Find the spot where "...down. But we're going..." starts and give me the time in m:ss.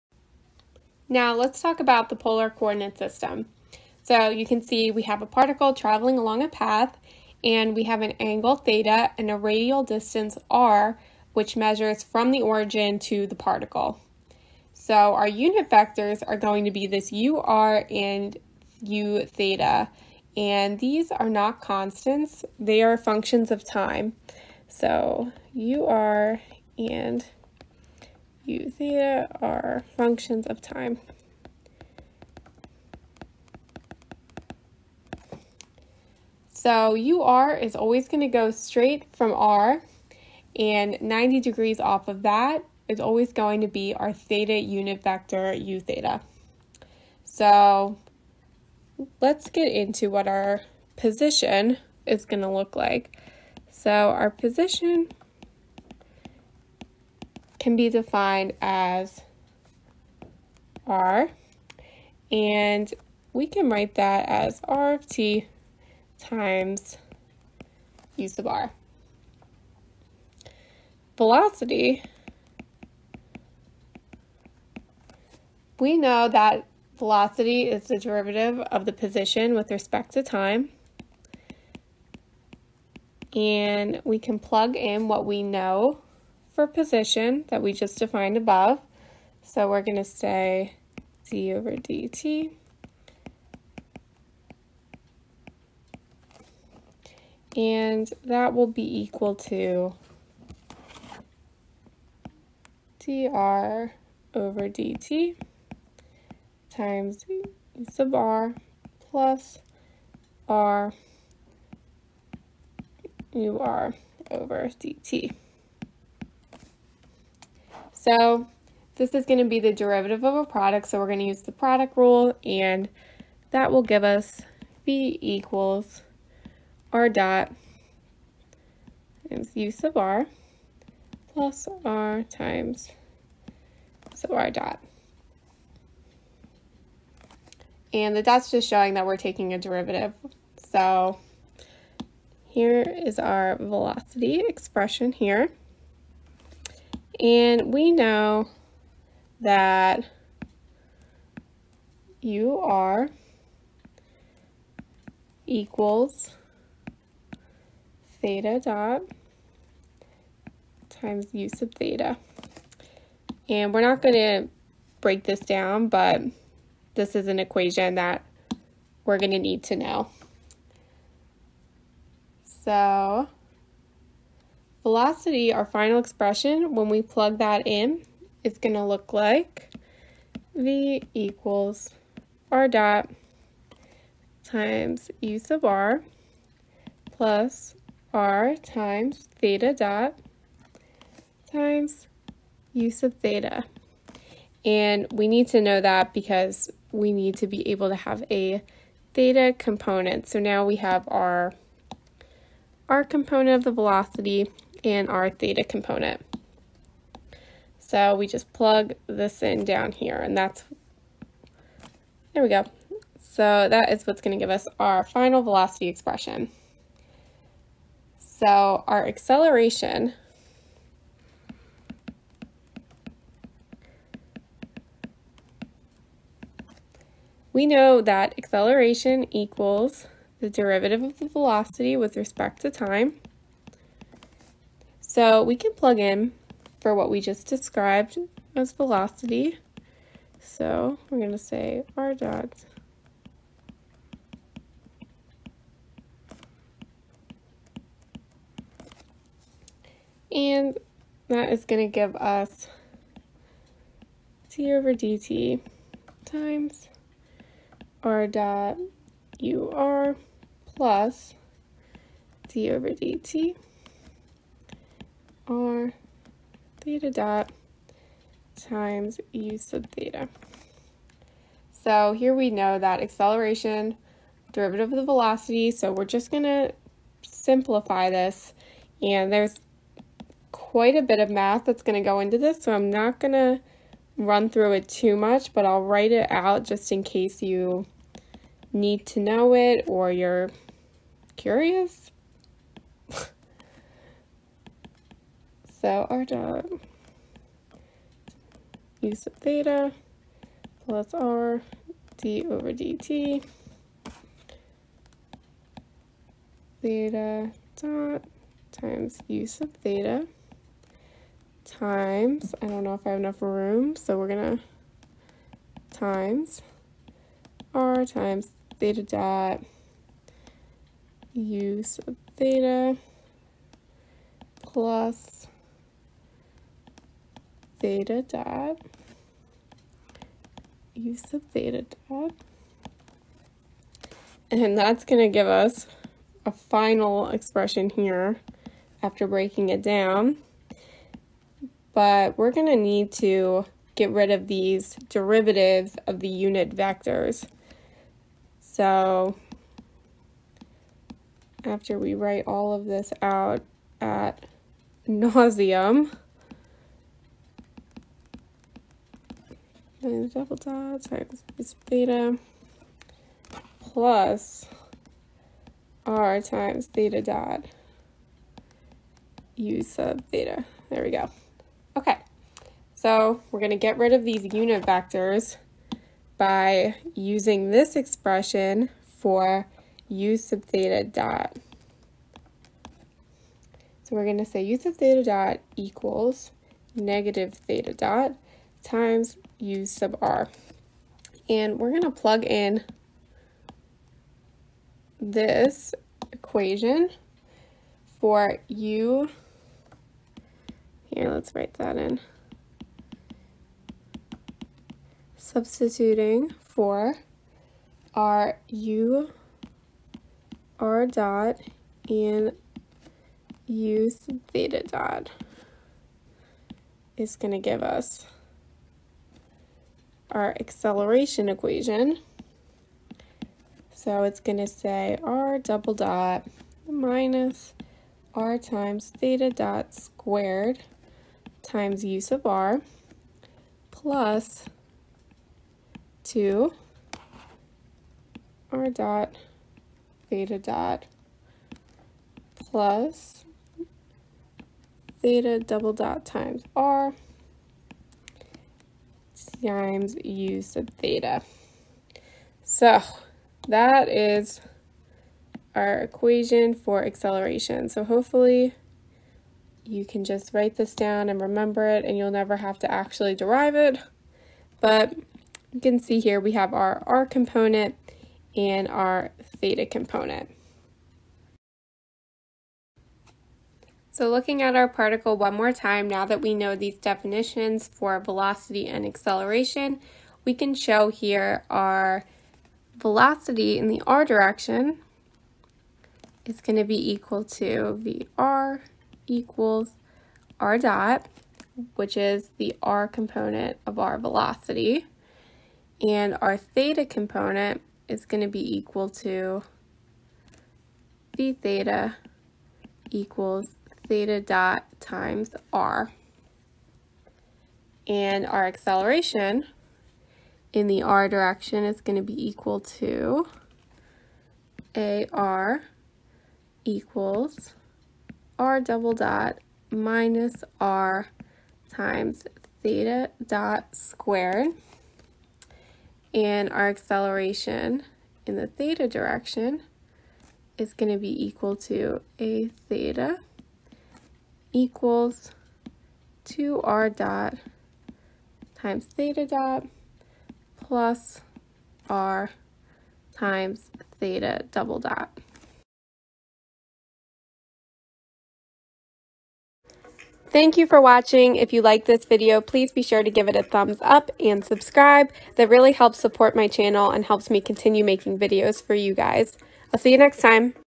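5:39.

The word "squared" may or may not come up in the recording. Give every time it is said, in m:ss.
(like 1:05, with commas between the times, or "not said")
7:09, 8:43.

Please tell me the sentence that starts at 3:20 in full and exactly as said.
So now we have our, our component of the velocity and our theta component.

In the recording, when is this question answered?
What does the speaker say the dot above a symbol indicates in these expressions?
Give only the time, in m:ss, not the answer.
2:19.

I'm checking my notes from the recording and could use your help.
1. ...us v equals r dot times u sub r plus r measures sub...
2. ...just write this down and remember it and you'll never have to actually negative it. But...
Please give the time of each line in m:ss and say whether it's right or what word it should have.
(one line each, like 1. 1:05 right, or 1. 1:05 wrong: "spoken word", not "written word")
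1. 2:04 wrong: "times", not "measures"
2. 7:40 wrong: "derive", not "negative".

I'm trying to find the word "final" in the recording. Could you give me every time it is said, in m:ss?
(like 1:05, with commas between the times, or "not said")
2:55, 3:35, 5:36.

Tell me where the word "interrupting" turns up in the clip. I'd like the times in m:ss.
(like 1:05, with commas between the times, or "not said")
not said.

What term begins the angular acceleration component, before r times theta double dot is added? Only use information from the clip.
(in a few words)
2r dot times theta dot.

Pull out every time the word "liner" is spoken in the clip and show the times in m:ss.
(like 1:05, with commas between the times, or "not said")
not said.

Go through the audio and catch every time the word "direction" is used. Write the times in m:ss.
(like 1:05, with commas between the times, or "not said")
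8:04, 8:31, 8:49.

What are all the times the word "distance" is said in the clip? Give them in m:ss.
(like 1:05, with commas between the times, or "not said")
0:09.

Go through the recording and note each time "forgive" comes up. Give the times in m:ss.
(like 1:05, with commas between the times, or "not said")
not said.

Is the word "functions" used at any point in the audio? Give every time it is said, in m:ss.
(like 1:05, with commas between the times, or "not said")
0:22, 0:29.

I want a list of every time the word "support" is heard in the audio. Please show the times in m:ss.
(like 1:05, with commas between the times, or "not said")
9:16.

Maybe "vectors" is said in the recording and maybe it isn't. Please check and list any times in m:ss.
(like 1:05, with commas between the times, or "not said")
0:15, 0:45, 5:46, 6:14.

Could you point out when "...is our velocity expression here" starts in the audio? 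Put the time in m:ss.
2:23.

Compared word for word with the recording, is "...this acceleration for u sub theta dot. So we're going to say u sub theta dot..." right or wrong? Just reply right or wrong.
wrong.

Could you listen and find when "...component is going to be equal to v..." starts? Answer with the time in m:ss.
8:17.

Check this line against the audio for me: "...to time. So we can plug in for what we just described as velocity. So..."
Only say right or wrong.
right.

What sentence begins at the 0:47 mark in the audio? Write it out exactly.
So let's get into what our position is going to look like.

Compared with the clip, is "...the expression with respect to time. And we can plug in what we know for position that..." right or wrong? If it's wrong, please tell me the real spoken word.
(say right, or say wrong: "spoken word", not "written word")
wrong: "position", not "expression".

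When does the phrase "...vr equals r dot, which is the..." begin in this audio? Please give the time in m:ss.
8:08.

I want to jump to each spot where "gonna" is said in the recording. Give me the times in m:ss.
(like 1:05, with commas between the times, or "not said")
3:34, 5:14.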